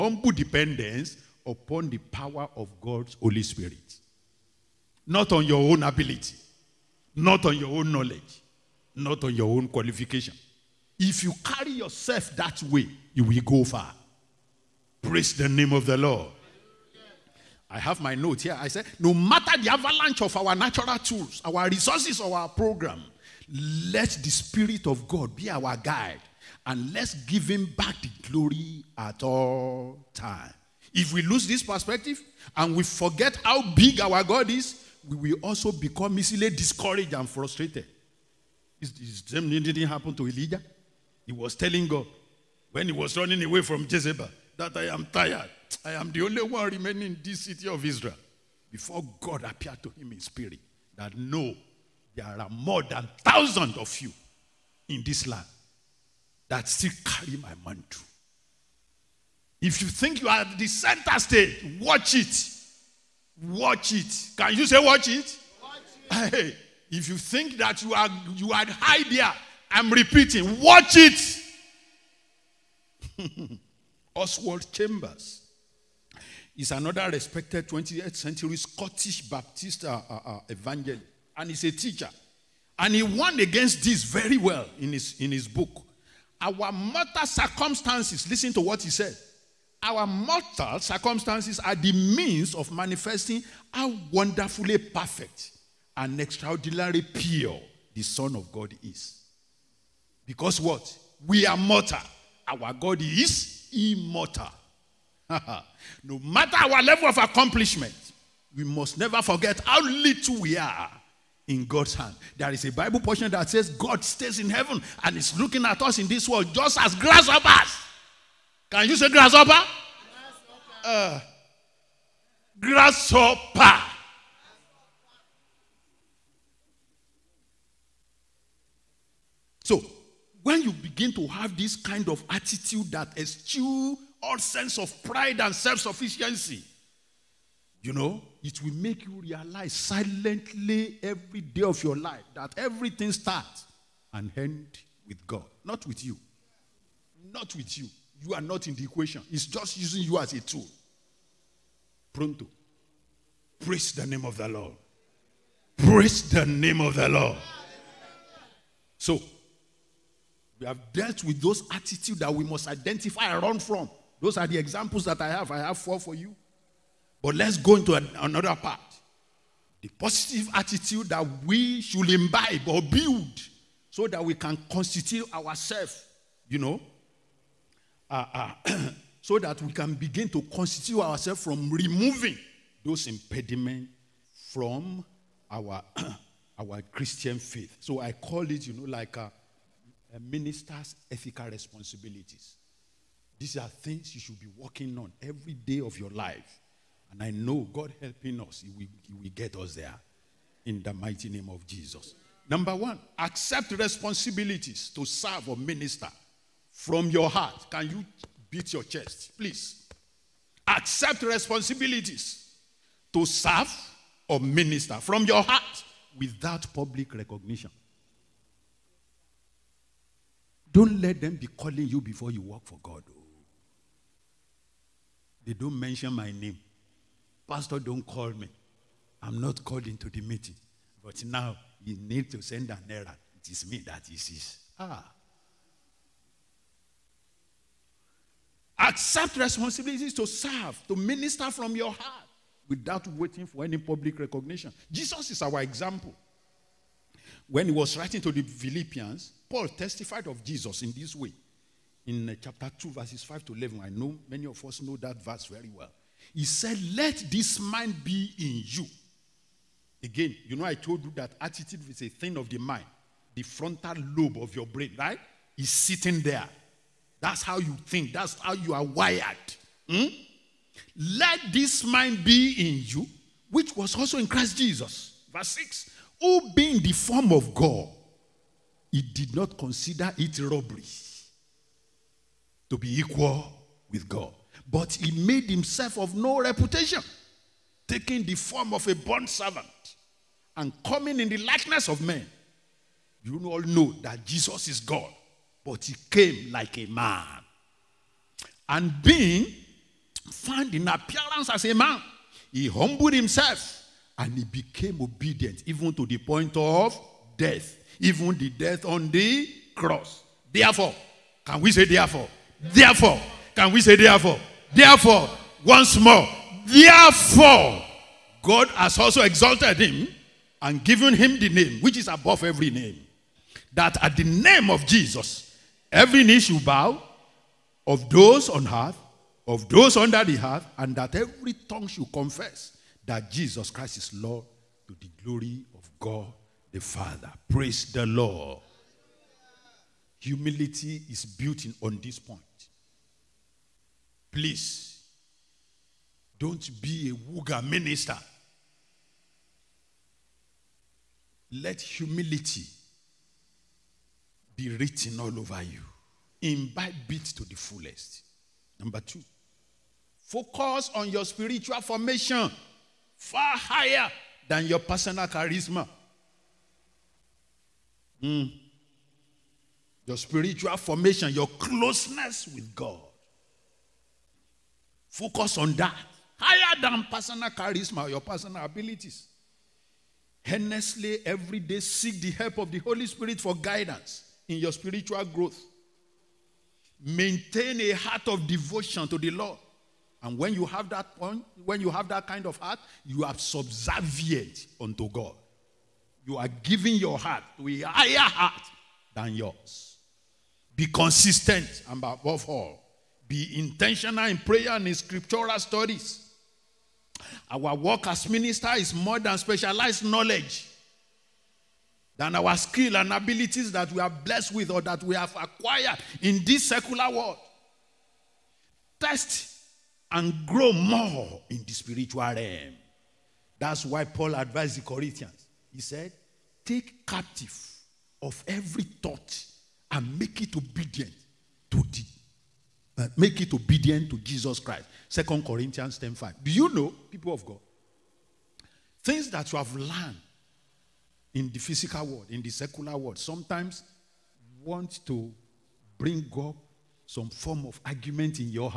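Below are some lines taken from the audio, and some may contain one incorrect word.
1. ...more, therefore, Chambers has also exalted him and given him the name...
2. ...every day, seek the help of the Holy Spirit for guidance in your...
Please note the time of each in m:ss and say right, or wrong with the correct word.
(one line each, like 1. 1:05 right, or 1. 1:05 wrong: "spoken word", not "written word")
1. 5:15 wrong: "God", not "Chambers"
2. 6:21 right.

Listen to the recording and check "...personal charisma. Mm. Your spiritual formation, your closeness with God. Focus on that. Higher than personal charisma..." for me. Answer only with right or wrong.
right.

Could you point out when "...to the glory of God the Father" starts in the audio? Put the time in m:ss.
5:34.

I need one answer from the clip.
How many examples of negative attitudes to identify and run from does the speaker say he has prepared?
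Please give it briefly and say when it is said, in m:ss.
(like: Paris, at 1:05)
4, at 2:45.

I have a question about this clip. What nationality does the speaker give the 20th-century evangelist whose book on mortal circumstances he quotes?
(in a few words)
Scottish.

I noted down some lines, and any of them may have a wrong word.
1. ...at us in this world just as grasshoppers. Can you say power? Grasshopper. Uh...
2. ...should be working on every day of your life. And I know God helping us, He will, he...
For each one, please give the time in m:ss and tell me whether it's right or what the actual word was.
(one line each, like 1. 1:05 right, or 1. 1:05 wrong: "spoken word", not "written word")
1. 1:55 wrong: "grasshopper", not "power"
2. 3:14 right.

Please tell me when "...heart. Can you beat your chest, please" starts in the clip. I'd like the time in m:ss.
3:27.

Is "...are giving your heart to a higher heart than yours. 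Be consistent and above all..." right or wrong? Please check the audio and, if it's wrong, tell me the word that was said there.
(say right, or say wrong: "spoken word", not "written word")
right.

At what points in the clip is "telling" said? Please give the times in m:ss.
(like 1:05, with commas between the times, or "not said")
0:41.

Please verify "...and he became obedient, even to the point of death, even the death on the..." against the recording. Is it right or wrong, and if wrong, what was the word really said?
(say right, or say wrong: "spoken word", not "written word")
right.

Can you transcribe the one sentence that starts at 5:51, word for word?
Let humility be written all over you.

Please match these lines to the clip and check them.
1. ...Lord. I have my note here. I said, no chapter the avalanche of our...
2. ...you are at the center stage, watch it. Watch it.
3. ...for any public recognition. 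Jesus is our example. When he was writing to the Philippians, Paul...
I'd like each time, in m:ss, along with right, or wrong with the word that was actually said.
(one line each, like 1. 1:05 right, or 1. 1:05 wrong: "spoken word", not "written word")
1. 0:15 wrong: "matter", not "chapter"
2. 1:00 right
3. 4:03 right.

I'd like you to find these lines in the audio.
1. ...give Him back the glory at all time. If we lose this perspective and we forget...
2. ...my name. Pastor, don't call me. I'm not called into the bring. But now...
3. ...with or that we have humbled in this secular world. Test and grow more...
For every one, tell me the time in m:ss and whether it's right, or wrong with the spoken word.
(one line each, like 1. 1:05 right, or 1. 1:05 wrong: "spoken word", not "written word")
1. 0:27 right
2. 3:46 wrong: "meeting", not "bring"
3. 6:54 wrong: "acquired", not "humbled".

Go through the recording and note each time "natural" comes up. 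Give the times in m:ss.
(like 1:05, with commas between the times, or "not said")
0:20.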